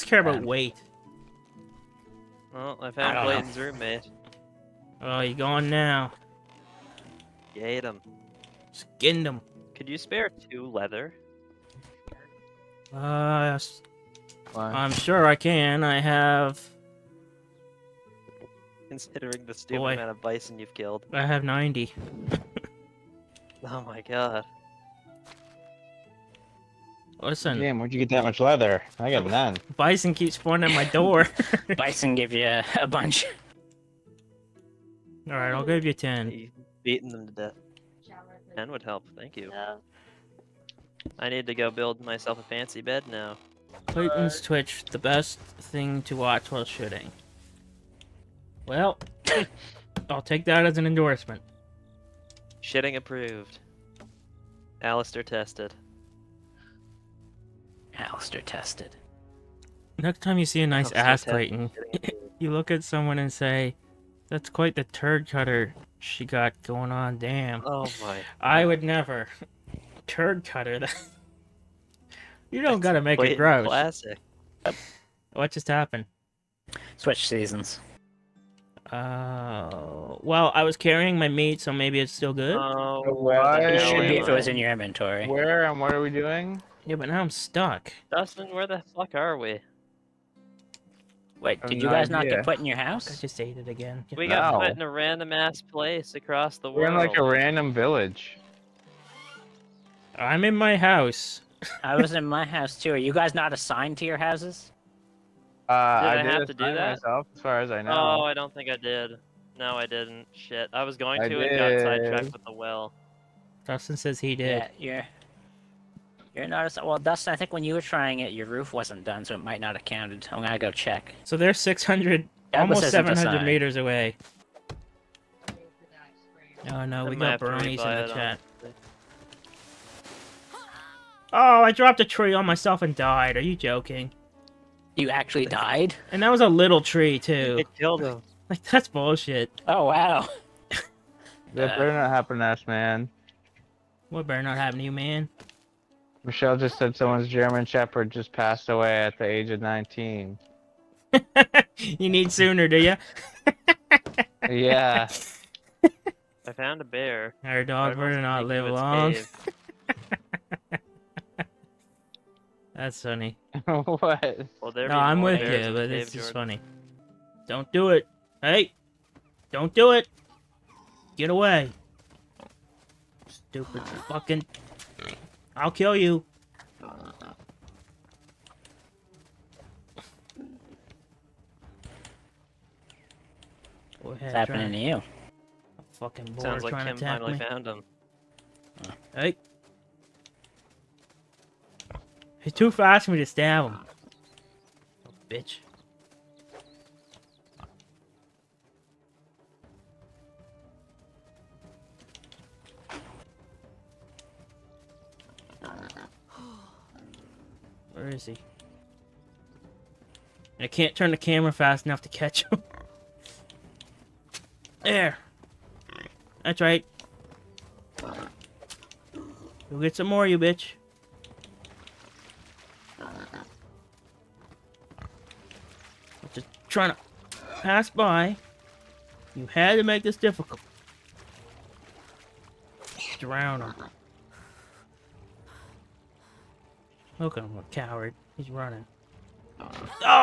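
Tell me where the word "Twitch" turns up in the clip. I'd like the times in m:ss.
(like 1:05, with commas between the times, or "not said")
0:44.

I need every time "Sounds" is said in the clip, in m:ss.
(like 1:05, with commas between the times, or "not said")
3:06.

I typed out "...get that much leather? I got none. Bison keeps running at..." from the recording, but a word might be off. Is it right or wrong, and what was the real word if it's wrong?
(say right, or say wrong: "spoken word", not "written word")
wrong: "spawning", not "running".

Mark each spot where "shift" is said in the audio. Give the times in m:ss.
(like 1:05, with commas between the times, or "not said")
not said.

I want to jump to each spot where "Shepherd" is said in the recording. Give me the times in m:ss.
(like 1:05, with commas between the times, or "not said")
2:27.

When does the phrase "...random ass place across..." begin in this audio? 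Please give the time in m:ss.
1:34.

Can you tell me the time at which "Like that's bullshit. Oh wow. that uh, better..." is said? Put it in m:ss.
2:18.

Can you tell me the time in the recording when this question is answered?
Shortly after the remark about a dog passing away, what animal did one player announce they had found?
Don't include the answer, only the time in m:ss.
2:36.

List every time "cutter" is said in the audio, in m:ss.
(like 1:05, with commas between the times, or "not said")
1:05, 1:10.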